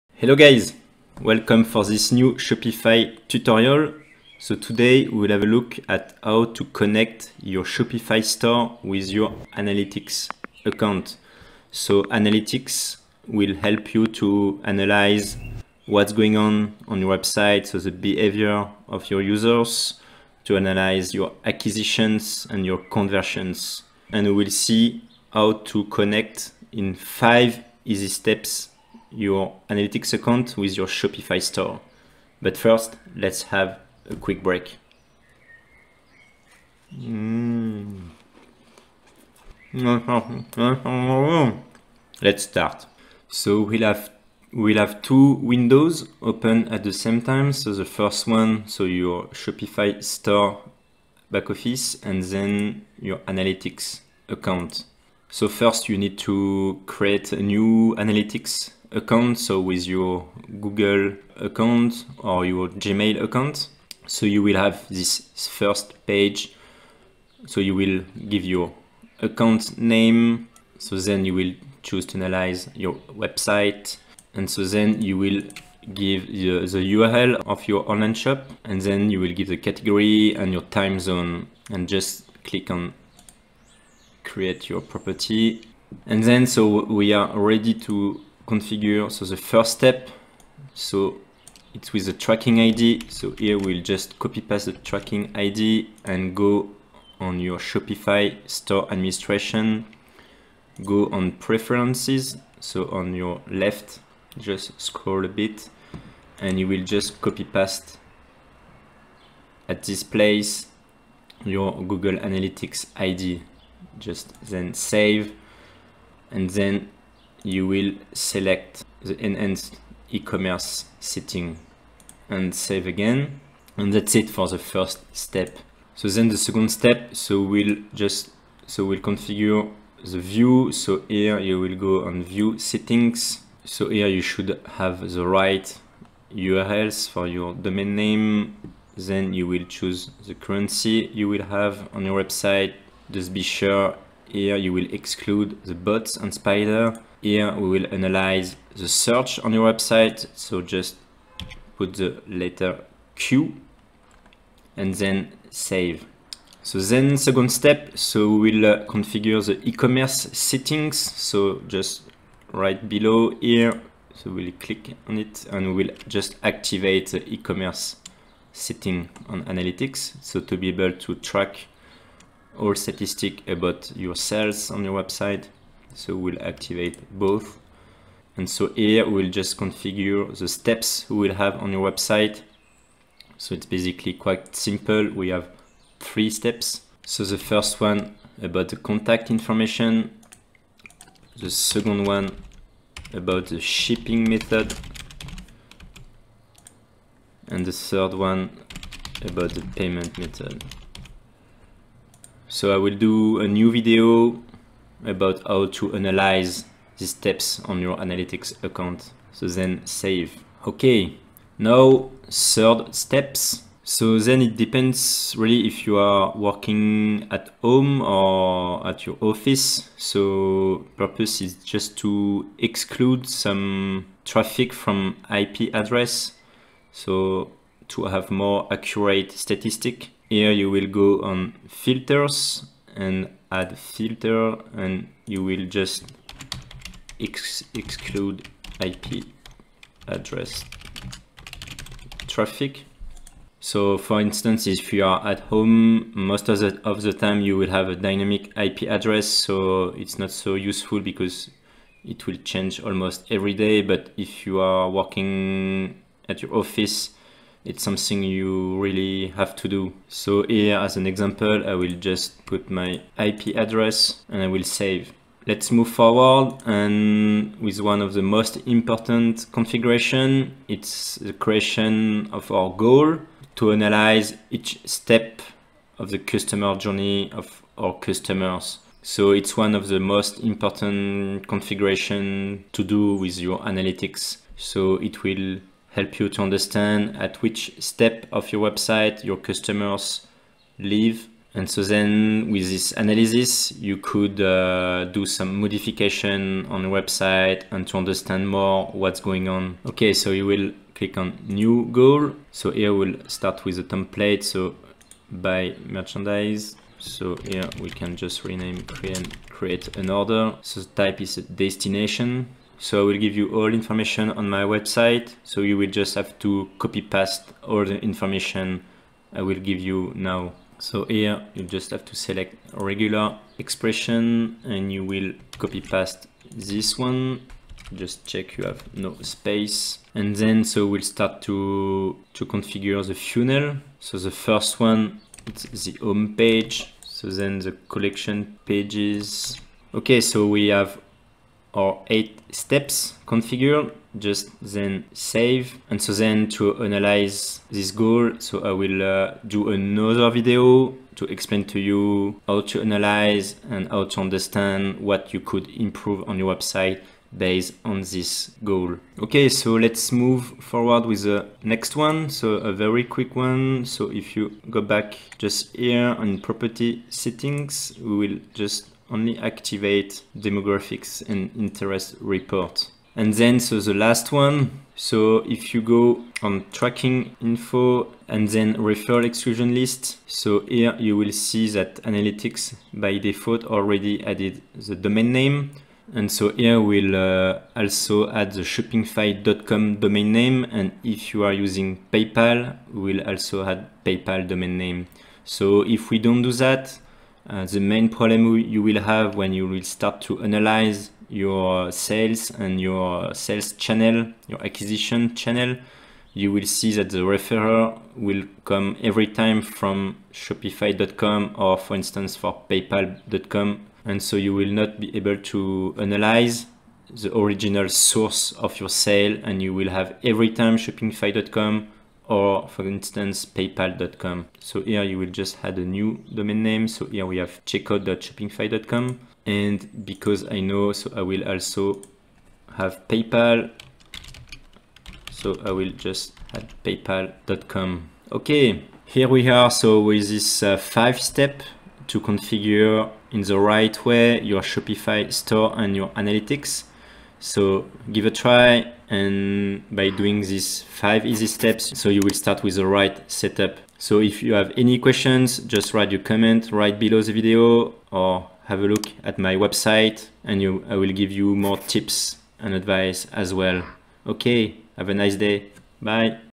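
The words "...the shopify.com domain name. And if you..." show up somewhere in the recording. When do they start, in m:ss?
6:28.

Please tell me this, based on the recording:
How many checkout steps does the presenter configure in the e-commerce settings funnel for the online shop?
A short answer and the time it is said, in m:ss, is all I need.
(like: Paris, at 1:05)
3, at 3:05.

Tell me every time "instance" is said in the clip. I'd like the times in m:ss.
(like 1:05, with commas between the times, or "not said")
4:04, 6:51, 7:02.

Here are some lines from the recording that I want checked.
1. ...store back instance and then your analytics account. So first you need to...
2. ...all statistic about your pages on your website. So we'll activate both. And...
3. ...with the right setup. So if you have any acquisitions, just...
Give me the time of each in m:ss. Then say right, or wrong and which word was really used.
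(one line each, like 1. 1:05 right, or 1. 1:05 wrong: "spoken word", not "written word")
1. 0:50 wrong: "office", not "instance"
2. 2:52 wrong: "sales", not "pages"
3. 7:32 wrong: "questions", not "acquisitions".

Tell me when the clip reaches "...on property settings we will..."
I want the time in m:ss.
6:06.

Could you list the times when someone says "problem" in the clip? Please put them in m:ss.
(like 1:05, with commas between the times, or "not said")
6:38.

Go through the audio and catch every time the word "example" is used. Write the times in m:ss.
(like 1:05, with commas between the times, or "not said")
4:21.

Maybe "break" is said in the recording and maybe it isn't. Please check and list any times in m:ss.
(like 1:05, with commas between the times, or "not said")
0:34.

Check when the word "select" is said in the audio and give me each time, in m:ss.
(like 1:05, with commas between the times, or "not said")
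1:58, 5:22.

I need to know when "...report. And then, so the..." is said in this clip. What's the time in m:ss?
6:12.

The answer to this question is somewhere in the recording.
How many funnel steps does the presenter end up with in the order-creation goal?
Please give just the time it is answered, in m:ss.
5:42.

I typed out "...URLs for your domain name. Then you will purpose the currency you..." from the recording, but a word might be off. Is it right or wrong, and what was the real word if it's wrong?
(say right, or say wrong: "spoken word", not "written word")
wrong: "choose", not "purpose".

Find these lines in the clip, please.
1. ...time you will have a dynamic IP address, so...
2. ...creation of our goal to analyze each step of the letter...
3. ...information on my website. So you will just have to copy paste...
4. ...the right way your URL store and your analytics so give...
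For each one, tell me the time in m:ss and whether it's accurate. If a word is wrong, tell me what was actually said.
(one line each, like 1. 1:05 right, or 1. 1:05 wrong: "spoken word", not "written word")
1. 4:07 right
2. 4:31 wrong: "customer", not "letter"
3. 5:13 right
4. 7:23 wrong: "Shopify", not "URL".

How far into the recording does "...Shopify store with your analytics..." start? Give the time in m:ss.
0:07.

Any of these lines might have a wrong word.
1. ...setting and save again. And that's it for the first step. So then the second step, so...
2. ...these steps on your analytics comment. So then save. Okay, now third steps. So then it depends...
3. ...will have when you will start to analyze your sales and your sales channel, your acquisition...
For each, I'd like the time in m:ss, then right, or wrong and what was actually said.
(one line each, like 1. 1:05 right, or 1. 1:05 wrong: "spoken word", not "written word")
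1. 2:00 right
2. 3:26 wrong: "account", not "comment"
3. 6:38 right.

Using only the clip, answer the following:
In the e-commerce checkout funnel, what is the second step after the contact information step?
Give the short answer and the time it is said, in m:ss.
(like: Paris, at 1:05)
shipping method, at 3:13.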